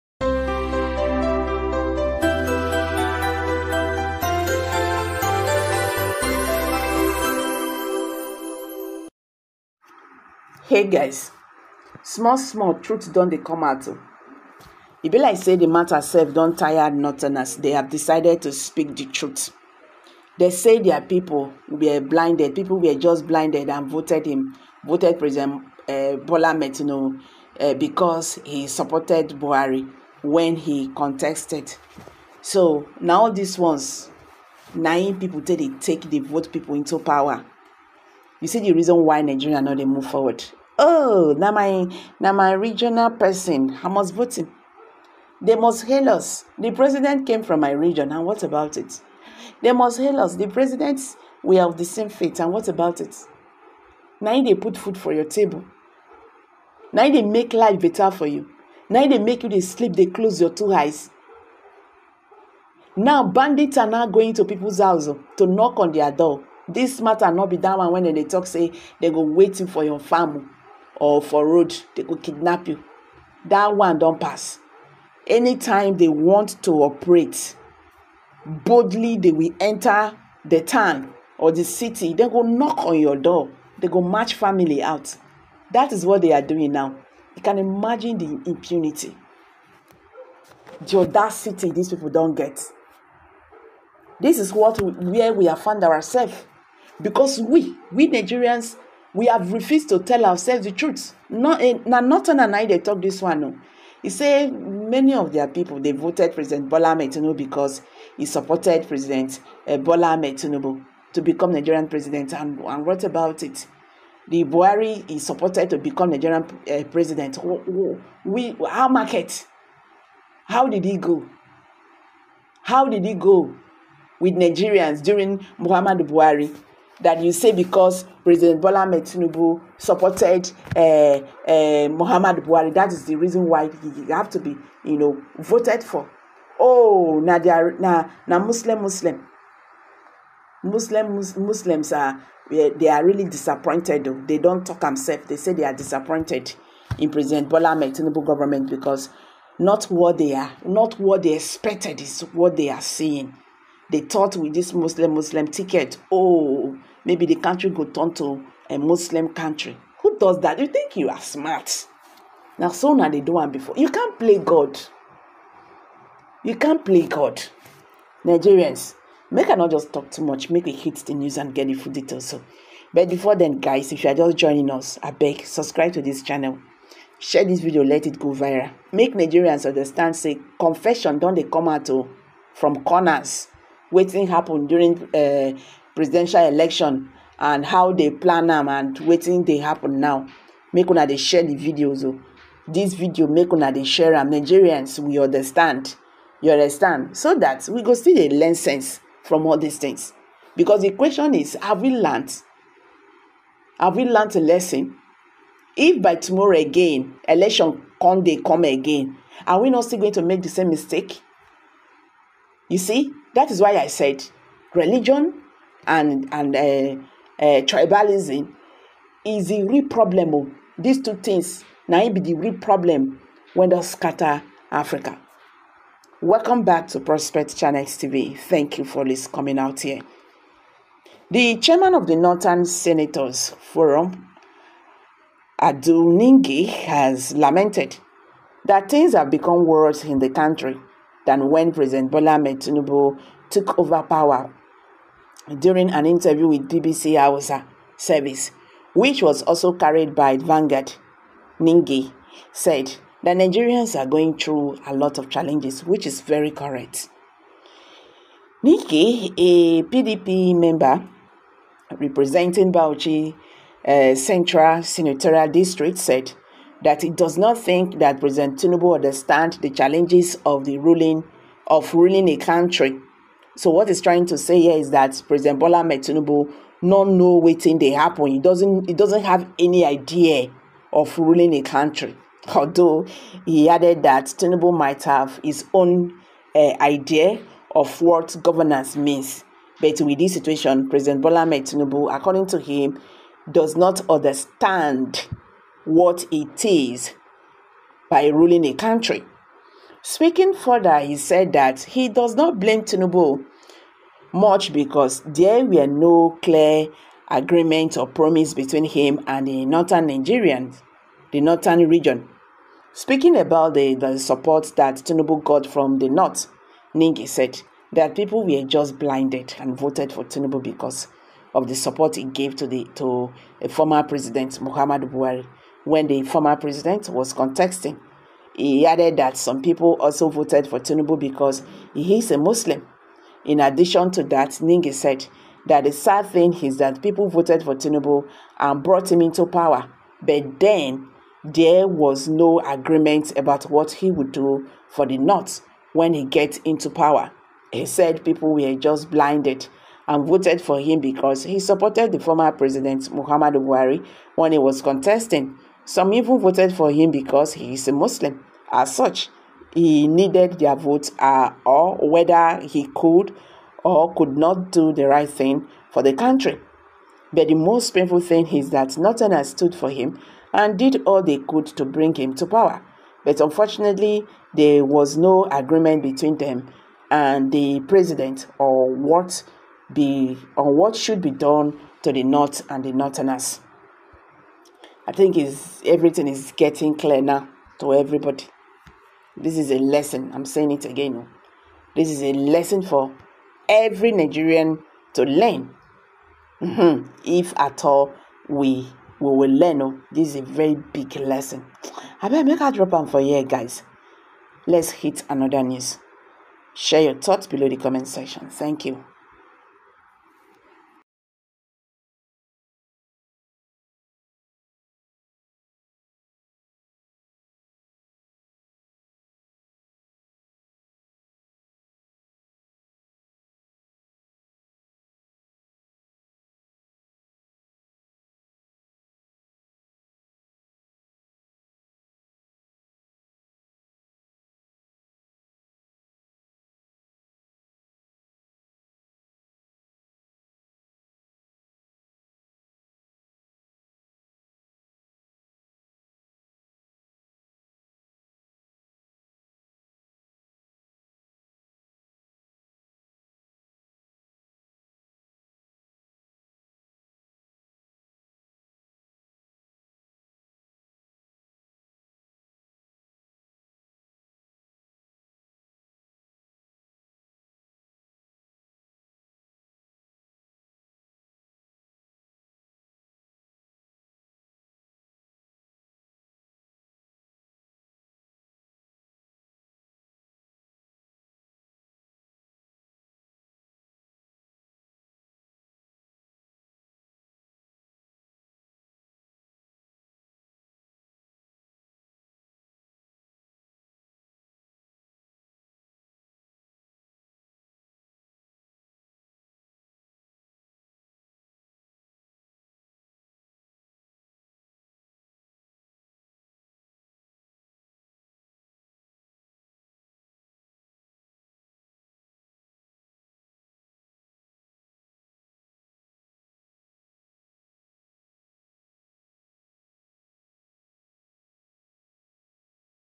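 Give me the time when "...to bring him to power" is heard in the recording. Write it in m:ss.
6:11.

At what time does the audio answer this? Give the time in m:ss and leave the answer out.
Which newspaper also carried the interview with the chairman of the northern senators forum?
4:10.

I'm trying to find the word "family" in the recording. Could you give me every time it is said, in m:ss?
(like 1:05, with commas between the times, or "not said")
1:09, 1:24.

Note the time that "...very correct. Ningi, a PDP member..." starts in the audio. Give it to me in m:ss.
4:16.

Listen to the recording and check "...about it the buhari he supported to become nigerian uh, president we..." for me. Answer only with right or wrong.
right.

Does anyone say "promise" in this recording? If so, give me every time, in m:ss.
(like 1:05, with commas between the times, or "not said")
5:08.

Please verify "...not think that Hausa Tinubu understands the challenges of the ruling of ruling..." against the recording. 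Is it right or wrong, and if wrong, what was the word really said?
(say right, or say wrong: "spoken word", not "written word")
wrong: "President", not "Hausa".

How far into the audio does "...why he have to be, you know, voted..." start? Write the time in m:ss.
2:13.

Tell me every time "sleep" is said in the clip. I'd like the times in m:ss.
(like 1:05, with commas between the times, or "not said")
0:59.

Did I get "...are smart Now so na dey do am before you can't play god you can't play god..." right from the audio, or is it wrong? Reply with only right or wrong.
right.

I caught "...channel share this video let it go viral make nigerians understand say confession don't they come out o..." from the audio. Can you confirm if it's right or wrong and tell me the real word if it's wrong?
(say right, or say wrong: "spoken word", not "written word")
right.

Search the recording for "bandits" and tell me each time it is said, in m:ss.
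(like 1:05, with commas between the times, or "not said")
1:03.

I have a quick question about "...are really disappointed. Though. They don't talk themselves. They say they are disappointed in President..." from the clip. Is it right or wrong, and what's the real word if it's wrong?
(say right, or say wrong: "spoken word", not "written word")
right.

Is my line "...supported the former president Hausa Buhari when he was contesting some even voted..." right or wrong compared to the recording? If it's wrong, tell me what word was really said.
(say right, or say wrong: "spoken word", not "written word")
wrong: "Muhammadu", not "Hausa".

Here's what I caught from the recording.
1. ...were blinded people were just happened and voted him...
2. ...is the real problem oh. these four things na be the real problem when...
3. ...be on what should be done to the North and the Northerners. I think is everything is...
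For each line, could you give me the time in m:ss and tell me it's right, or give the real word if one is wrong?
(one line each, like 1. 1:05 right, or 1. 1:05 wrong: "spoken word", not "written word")
1. 0:21 wrong: "blinded", not "happened"
2. 3:39 wrong: "two", not "four"
3. 6:19 right.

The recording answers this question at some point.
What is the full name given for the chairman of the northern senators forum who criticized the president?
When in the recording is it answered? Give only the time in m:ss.
3:55.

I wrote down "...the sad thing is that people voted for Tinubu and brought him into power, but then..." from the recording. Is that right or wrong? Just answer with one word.
right.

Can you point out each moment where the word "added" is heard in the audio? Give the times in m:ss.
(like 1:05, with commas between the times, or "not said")
4:43, 5:28.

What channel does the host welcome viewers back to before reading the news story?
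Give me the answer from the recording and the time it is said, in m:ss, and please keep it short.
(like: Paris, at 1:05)
Prospect Channels TV, at 3:46.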